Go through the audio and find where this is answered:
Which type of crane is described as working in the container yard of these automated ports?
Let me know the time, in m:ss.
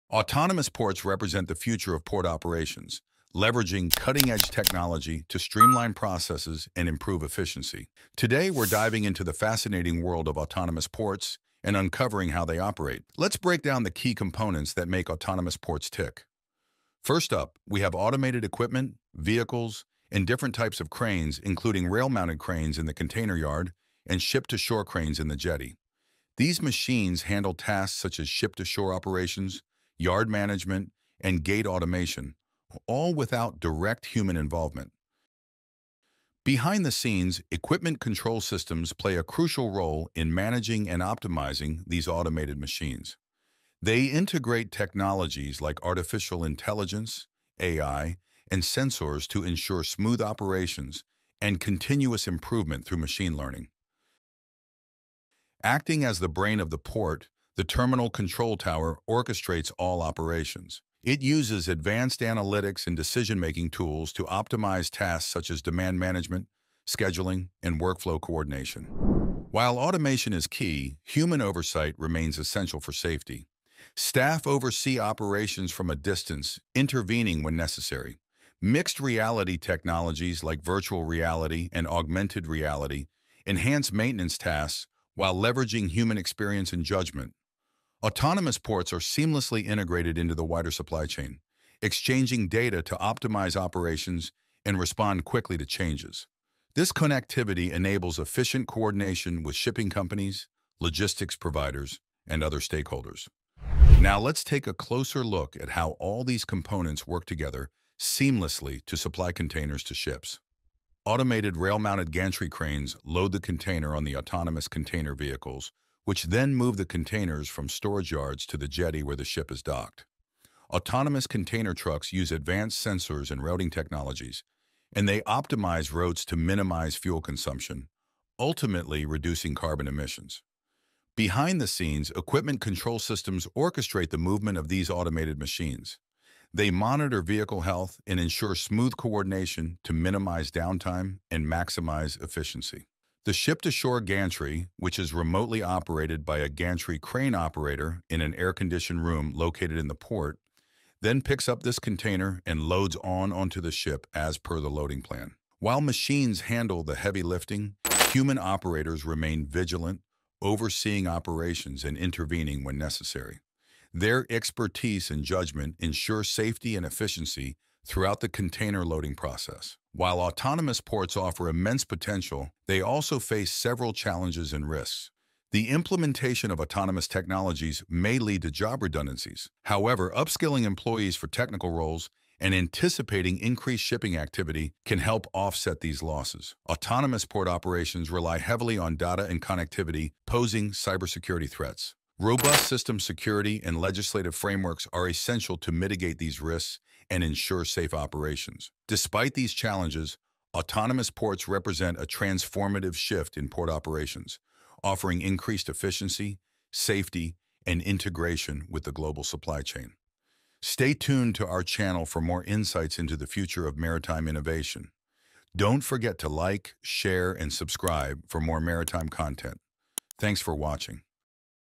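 0:21.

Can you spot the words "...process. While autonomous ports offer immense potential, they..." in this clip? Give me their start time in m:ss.
2:49.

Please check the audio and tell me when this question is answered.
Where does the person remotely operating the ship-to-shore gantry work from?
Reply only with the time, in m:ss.
2:28.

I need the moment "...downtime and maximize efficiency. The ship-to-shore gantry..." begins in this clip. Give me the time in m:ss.
2:20.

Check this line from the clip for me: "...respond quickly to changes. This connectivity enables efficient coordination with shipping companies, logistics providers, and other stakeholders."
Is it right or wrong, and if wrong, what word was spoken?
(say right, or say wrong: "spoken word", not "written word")
right.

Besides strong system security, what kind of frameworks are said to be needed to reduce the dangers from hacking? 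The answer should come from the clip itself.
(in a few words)
Legislative frameworks.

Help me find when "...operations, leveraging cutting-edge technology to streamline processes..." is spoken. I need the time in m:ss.
0:02.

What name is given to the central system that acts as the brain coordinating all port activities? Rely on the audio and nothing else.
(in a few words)
Terminal Control Tower.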